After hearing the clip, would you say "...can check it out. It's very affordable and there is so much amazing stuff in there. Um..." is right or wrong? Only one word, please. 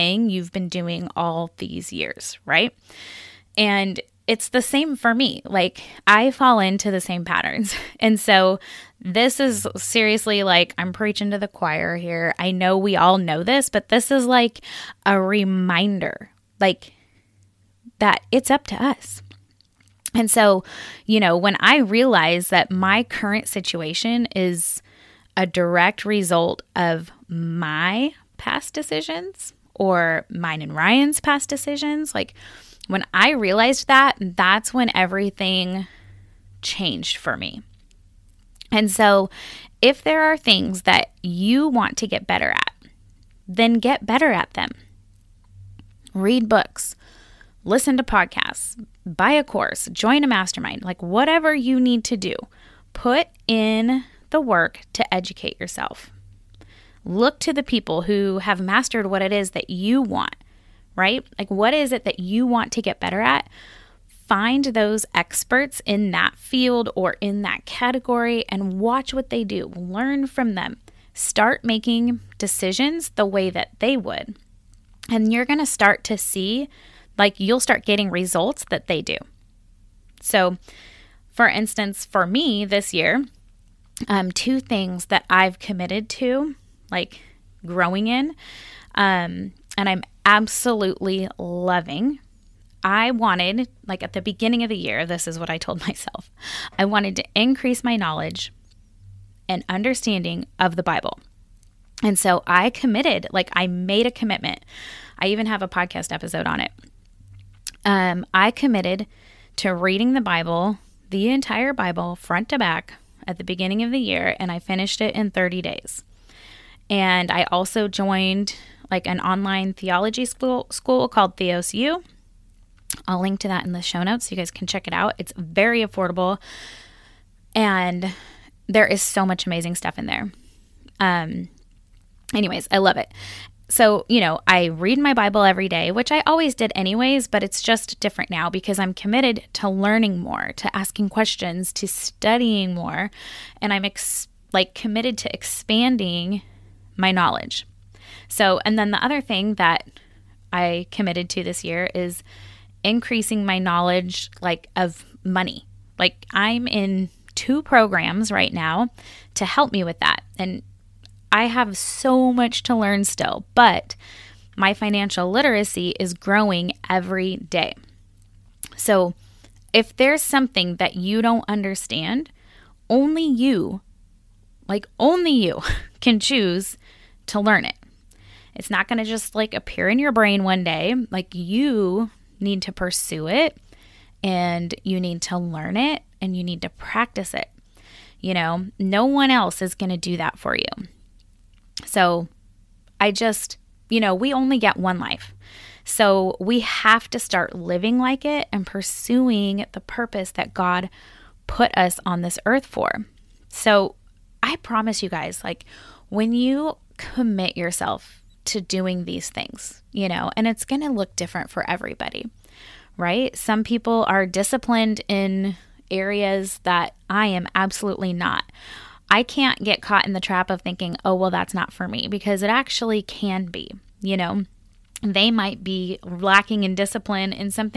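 right.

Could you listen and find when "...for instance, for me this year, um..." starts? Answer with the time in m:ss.
1:21.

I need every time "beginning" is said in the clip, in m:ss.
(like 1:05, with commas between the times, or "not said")
1:34, 1:53.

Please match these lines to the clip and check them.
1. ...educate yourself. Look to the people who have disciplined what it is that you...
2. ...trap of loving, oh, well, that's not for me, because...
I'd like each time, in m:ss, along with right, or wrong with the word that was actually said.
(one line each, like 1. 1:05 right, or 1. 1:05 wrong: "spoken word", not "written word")
1. 0:55 wrong: "mastered", not "disciplined"
2. 3:40 wrong: "thinking", not "loving".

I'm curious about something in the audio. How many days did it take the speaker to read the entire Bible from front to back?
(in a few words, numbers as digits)
30.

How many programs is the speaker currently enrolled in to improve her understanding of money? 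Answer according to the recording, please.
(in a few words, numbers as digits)
2.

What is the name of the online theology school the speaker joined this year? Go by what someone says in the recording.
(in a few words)
Theos U.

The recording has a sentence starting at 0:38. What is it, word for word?
And so, if there are things that you want to get better at, then get better at them.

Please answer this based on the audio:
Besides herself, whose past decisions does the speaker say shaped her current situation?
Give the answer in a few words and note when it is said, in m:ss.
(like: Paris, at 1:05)
Ryan, at 0:30.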